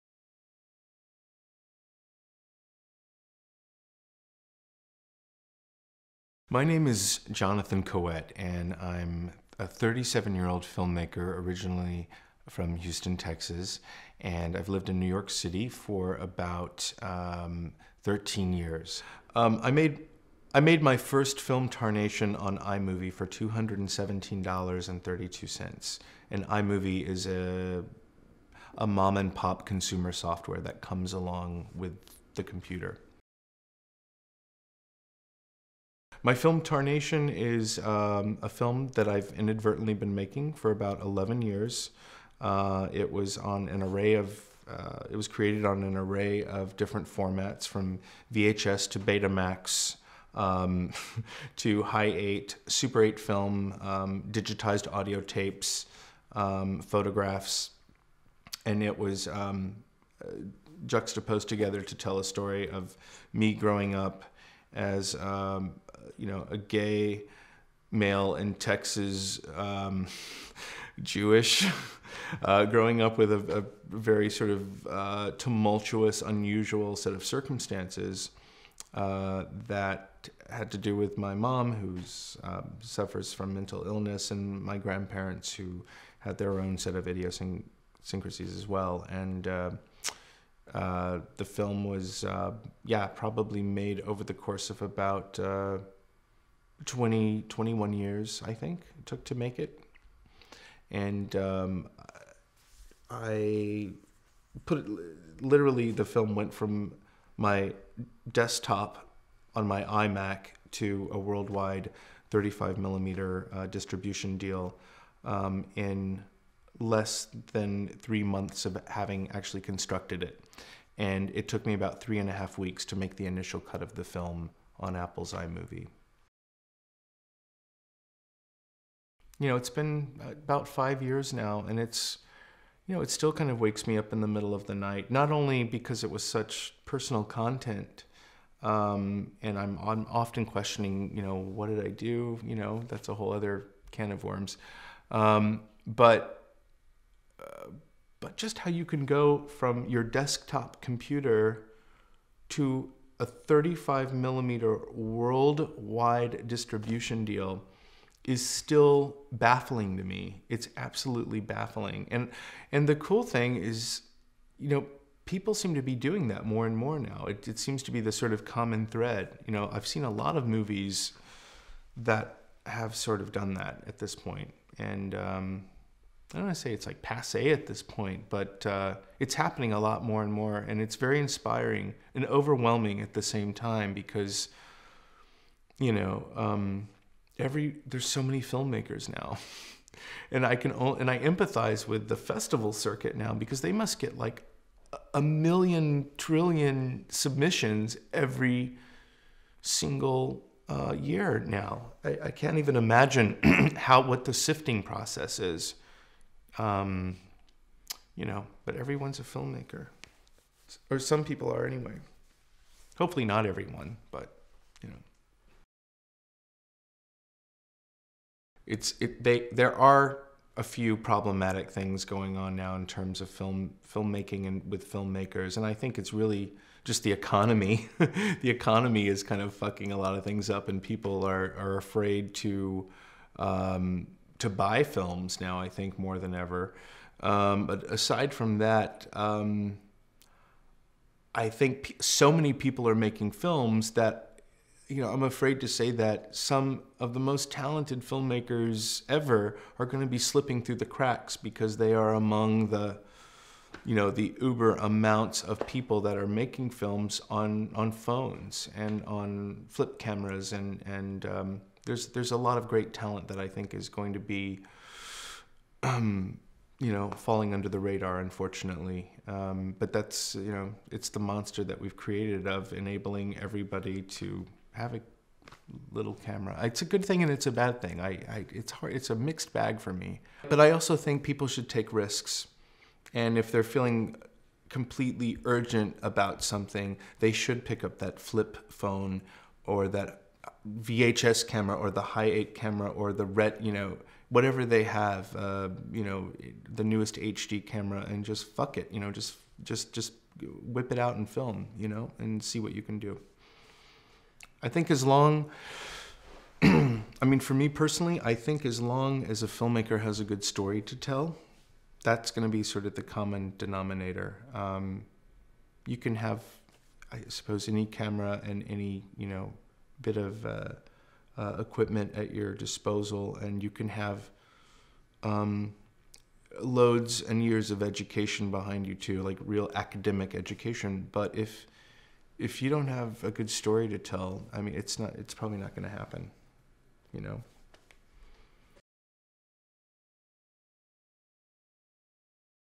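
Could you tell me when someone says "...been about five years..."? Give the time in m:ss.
2:09.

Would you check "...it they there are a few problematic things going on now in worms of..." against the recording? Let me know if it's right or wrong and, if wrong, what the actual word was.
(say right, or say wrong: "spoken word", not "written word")
wrong: "terms", not "worms".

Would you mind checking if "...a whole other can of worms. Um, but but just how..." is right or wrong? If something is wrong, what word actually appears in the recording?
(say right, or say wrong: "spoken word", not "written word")
right.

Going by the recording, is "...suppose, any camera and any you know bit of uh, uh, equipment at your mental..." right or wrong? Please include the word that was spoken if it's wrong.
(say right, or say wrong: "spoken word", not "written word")
wrong: "disposal", not "mental".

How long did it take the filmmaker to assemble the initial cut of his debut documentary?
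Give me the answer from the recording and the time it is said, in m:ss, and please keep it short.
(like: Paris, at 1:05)
three and a half weeks, at 2:02.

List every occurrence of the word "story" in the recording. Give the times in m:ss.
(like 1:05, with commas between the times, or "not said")
1:02, 5:10, 5:33.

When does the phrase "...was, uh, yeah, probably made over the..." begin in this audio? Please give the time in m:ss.
1:31.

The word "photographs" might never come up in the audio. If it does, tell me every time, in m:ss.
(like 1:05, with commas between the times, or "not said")
0:56.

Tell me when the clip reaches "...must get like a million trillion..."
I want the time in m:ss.
3:13.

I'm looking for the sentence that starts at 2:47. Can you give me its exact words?
It, it seems to be the sort of common thread.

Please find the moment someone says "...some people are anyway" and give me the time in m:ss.
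3:30.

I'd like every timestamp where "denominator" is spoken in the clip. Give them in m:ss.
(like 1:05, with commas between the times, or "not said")
5:13.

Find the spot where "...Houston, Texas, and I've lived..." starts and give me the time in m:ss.
0:12.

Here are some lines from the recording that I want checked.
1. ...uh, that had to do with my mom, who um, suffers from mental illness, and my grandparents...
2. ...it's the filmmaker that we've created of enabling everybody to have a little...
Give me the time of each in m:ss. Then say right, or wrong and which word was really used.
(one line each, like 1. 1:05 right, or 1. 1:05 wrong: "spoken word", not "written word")
1. 1:18 right
2. 4:30 wrong: "monster", not "filmmaker".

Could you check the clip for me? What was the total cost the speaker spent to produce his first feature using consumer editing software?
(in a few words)
$217.32.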